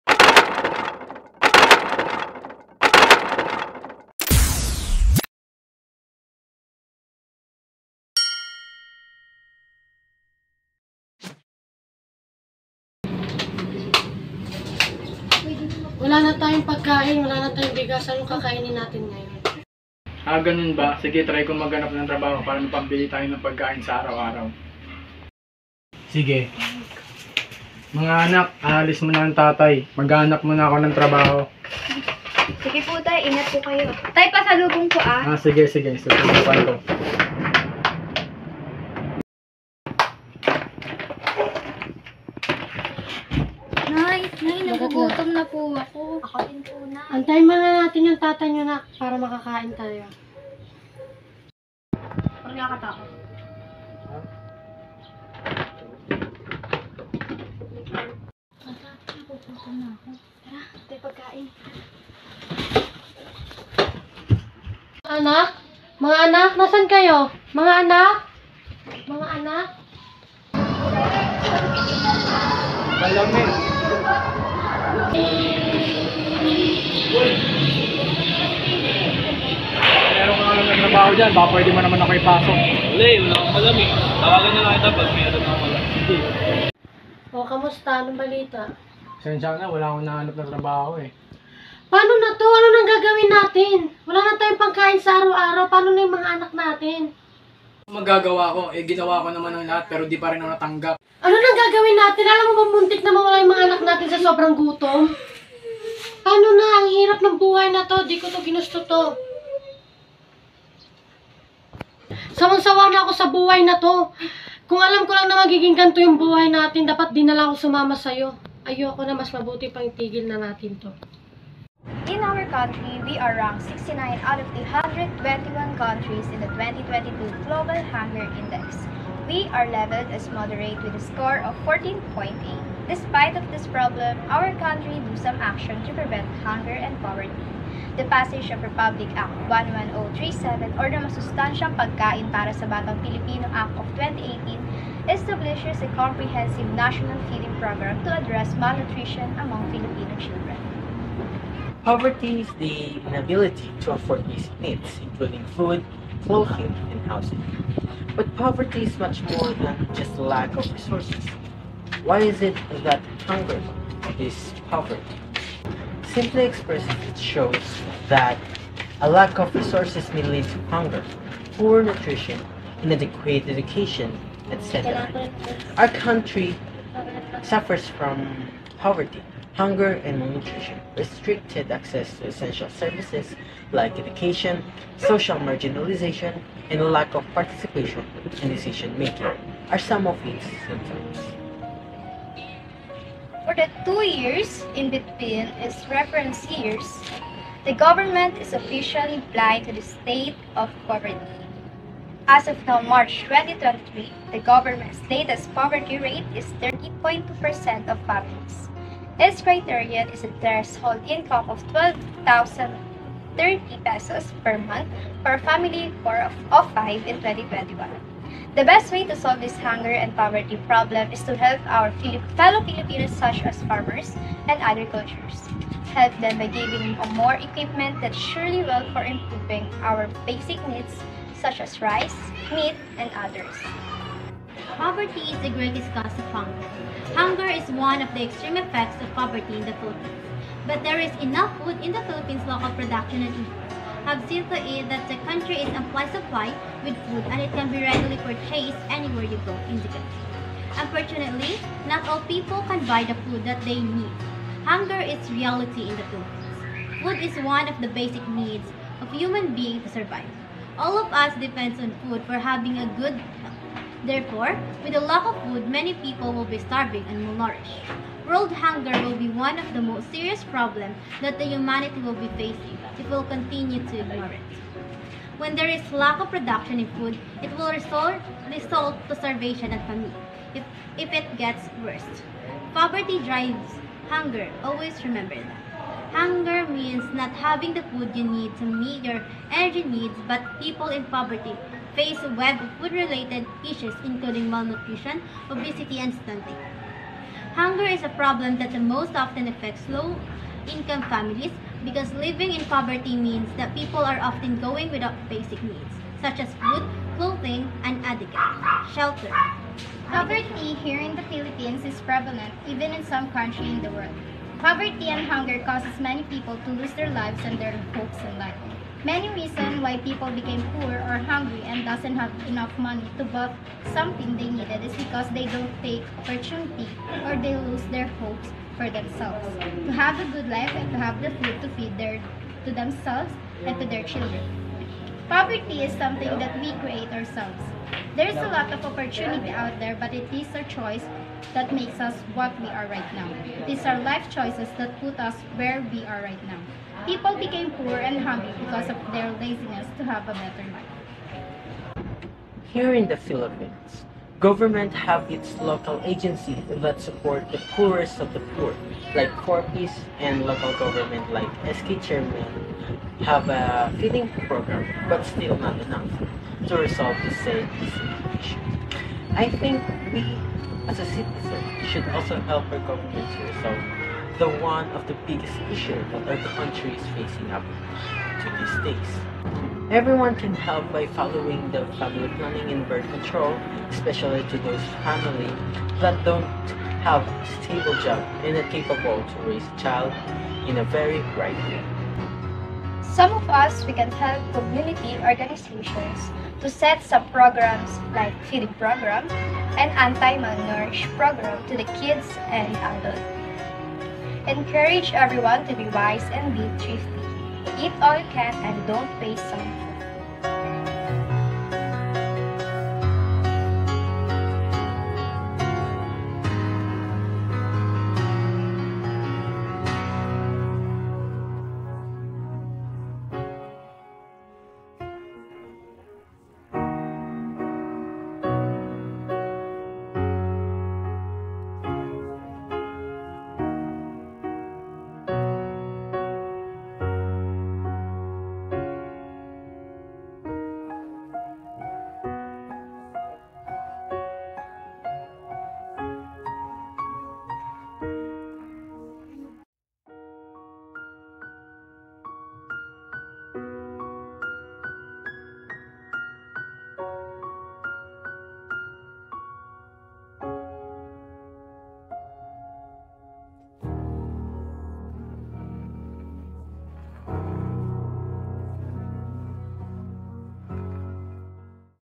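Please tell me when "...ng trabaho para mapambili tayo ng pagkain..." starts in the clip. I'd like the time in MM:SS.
00:21.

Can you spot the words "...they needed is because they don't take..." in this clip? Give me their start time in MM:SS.
05:24.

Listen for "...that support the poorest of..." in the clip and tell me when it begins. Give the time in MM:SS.
05:56.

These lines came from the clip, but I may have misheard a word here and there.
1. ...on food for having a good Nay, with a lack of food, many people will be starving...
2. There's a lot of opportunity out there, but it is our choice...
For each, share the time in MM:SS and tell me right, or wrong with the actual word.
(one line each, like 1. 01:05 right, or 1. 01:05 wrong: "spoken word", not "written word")
1. 04:21 wrong: "Therefore", not "Nay"
2. 05:38 right.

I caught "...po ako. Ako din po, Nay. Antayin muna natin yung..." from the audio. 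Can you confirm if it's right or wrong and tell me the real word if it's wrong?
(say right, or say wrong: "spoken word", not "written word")
right.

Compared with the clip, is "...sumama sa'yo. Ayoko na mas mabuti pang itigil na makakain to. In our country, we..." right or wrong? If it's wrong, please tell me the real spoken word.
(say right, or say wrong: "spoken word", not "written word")
wrong: "natin", not "makakain".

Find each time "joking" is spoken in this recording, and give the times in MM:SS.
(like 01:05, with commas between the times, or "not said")
not said.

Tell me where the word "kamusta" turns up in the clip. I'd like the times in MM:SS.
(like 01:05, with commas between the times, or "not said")
01:27.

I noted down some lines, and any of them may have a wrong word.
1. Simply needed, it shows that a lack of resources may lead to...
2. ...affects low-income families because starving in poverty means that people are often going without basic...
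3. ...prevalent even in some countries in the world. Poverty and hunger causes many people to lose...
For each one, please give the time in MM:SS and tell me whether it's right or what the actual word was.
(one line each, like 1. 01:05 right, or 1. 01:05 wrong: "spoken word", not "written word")
1. 02:46 wrong: "expressed", not "needed"
2. 04:59 wrong: "living", not "starving"
3. 05:12 right.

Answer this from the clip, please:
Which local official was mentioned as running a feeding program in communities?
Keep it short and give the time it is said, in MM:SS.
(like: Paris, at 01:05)
SK Chairman, at 06:01.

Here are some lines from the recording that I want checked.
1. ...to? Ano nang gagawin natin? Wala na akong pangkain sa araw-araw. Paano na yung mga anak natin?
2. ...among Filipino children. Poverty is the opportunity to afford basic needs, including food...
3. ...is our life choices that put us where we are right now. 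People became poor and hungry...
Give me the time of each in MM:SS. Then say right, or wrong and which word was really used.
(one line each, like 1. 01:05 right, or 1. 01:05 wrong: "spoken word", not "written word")
1. 01:32 wrong: "tayong", not "akong"
2. 02:29 wrong: "inability", not "opportunity"
3. 05:43 right.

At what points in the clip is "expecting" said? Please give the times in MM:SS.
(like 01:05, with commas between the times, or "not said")
not said.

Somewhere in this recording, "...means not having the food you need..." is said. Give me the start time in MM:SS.
04:46.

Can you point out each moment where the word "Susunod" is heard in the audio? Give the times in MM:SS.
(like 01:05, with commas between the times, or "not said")
00:36.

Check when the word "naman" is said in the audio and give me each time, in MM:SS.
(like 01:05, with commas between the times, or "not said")
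01:21, 01:39.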